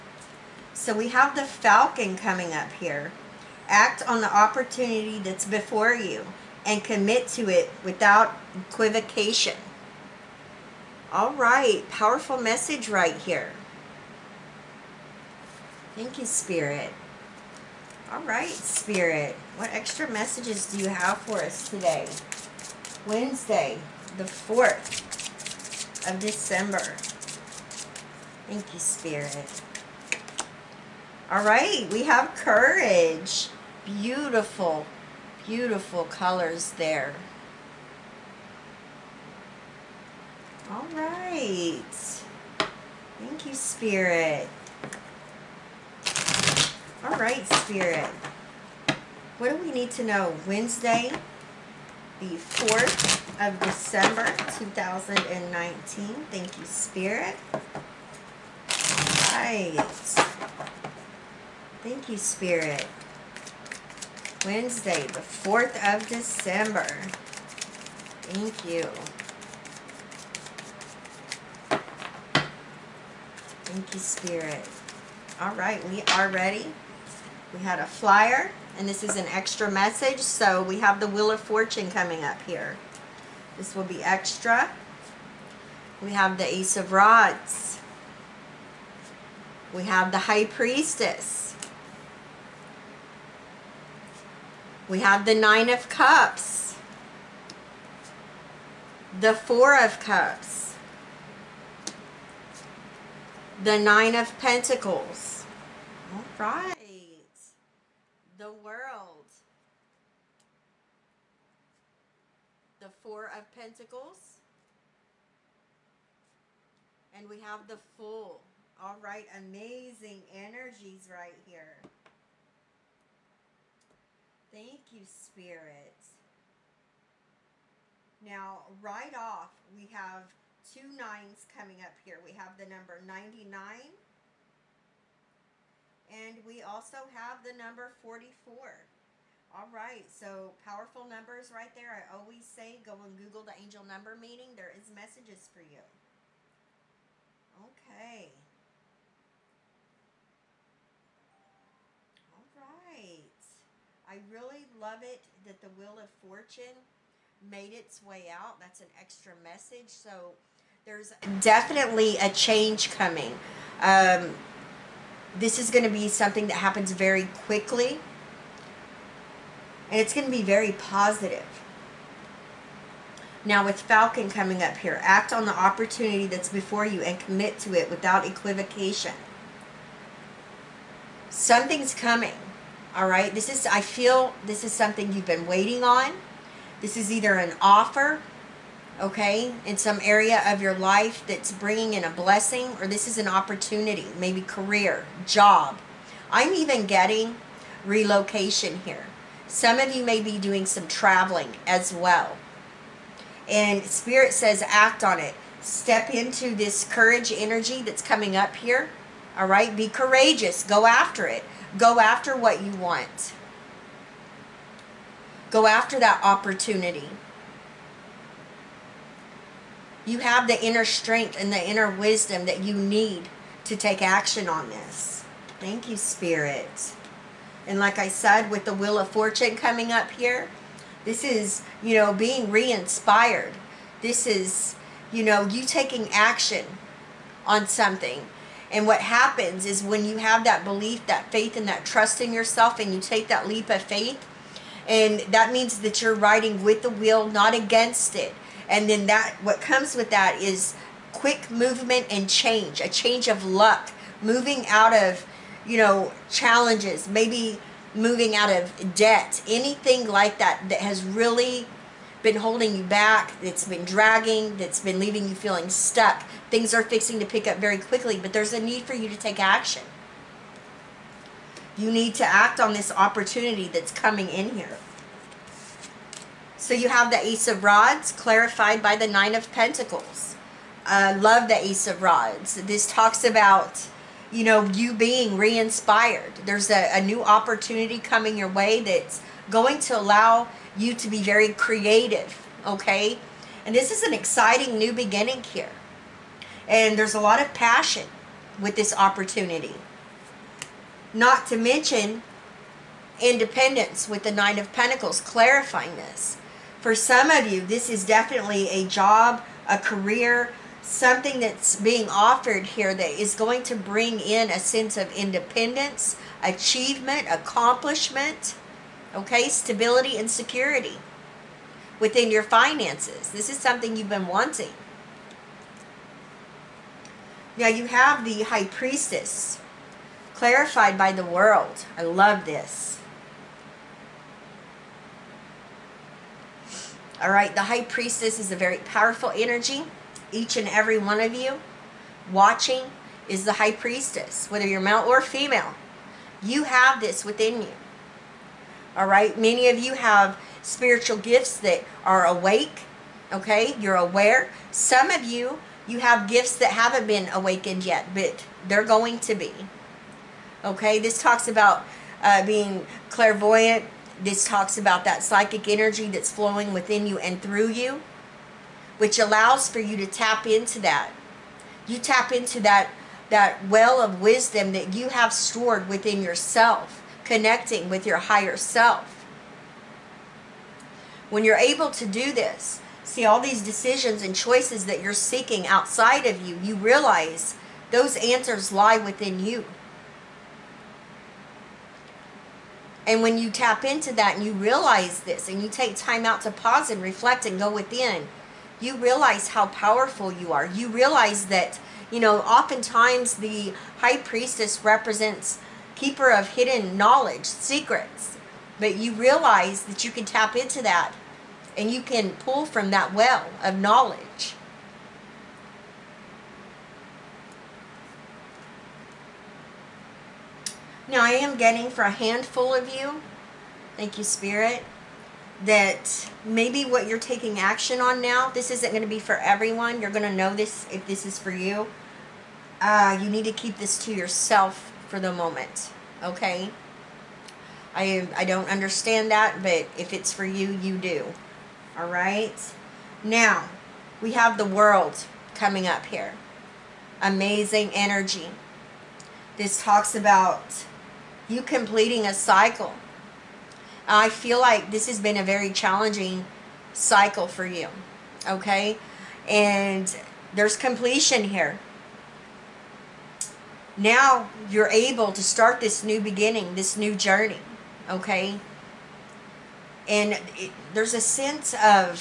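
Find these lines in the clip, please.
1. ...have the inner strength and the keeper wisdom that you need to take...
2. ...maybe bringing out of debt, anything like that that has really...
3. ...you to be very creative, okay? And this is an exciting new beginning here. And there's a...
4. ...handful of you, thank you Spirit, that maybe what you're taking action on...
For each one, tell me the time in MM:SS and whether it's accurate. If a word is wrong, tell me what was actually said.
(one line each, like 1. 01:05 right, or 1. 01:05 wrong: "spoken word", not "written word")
1. 03:40 wrong: "inner", not "keeper"
2. 04:17 wrong: "moving", not "bringing"
3. 04:50 right
4. 07:02 right.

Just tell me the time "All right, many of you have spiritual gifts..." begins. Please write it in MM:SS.
05:48.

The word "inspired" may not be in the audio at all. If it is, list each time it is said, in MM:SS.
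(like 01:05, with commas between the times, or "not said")
03:52, 04:45.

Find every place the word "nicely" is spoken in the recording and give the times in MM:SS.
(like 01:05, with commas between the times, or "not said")
not said.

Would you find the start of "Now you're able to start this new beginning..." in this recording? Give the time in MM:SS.
07:43.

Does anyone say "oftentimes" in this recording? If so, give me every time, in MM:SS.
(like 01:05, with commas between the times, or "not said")
06:42.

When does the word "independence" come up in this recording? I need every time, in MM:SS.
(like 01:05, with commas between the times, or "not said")
05:03, 05:15.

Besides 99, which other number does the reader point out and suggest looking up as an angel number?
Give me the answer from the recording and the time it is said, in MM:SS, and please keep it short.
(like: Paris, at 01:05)
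44, at 02:17.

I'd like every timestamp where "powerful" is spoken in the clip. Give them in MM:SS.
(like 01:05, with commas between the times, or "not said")
00:11, 02:20, 05:38, 06:39.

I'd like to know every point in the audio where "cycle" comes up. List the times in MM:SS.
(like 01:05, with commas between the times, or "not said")
07:32, 07:36.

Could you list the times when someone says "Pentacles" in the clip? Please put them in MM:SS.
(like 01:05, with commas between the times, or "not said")
01:44, 01:53, 04:39, 05:04.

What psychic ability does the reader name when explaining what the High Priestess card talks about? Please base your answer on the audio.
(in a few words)
Clairvoyant.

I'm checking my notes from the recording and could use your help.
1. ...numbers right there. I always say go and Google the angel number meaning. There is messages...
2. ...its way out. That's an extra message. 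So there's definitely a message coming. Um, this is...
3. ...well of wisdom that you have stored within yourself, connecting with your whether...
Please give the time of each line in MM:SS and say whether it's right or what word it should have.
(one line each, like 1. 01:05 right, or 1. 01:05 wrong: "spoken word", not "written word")
1. 02:21 right
2. 02:37 wrong: "change", not "message"
3. 06:13 wrong: "higher", not "whether".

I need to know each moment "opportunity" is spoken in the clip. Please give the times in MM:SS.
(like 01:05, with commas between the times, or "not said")
00:04, 02:55, 03:13, 03:36, 04:32, 04:47, 04:58.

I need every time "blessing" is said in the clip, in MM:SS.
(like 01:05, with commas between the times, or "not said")
03:12.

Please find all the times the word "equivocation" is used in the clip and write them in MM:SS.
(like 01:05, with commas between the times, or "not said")
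00:08, 02:58.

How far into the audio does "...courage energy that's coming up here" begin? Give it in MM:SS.
03:26.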